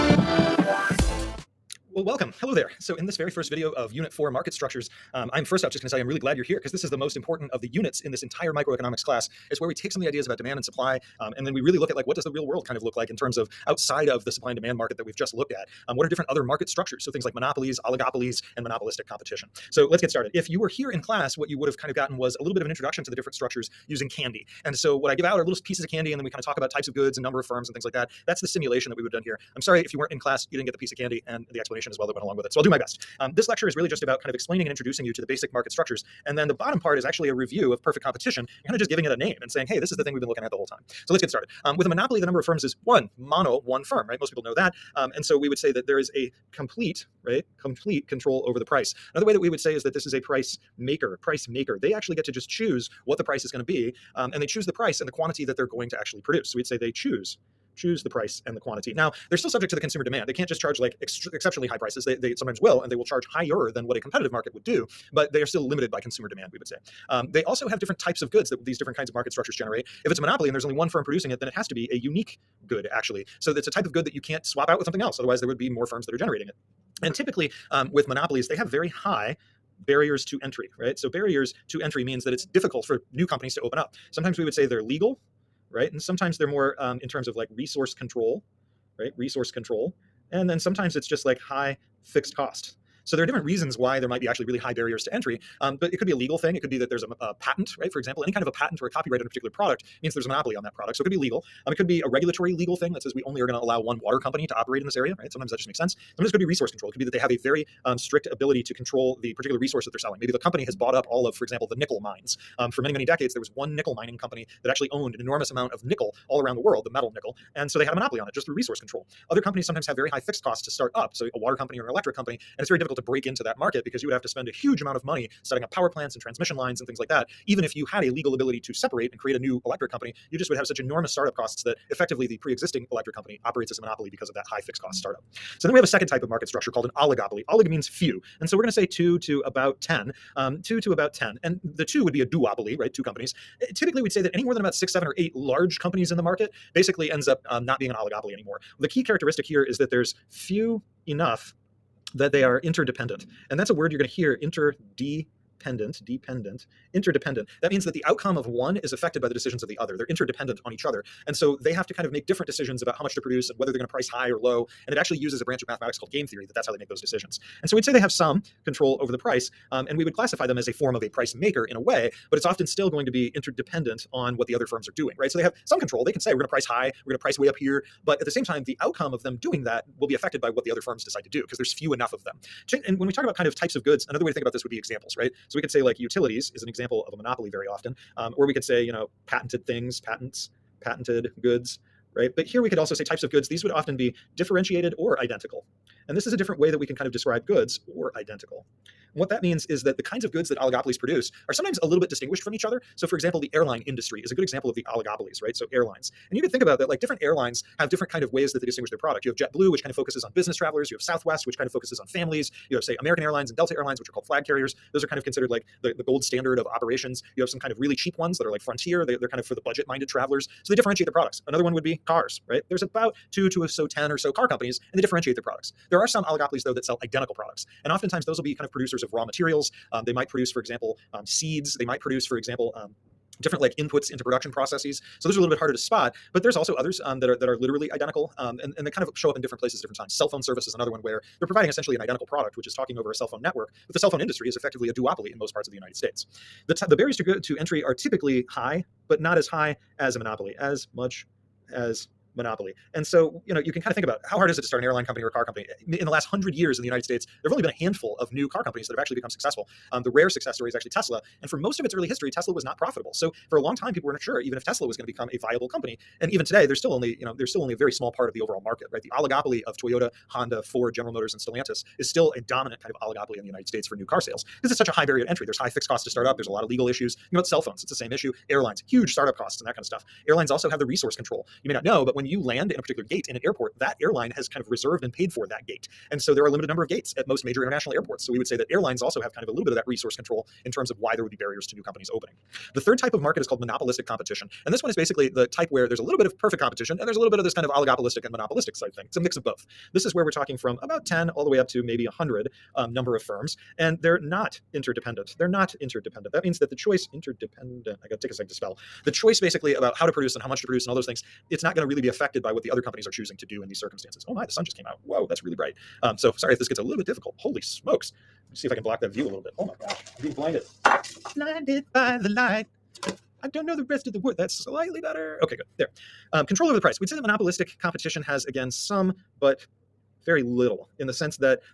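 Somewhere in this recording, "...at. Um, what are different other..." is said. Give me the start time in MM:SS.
00:15.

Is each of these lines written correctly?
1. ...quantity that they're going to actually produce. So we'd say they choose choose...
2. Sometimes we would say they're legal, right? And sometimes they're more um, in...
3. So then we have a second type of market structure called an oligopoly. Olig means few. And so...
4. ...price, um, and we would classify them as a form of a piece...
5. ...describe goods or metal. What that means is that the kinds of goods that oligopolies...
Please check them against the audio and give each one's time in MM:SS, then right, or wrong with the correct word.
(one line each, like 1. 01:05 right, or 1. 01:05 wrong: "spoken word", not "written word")
1. 00:55 right
2. 01:24 right
3. 02:15 right
4. 02:49 wrong: "price", not "piece"
5. 03:17 wrong: "identical", not "metal".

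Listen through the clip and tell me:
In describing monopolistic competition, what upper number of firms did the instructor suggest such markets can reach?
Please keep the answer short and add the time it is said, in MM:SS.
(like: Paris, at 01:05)
100, at 05:02.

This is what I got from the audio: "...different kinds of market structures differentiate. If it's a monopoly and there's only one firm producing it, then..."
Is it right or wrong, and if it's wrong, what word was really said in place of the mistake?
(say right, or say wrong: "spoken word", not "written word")
wrong: "generate", not "differentiate".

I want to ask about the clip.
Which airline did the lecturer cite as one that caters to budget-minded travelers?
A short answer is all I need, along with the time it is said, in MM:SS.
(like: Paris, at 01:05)
Frontier, at 03:38.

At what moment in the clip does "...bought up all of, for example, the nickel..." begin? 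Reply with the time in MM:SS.
01:50.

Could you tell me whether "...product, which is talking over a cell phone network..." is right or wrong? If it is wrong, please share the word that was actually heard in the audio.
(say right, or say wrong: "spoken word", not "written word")
right.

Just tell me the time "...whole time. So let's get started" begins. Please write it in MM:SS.
00:40.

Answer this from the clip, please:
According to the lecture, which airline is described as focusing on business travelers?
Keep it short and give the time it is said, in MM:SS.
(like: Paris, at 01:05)
JetBlue, at 03:29.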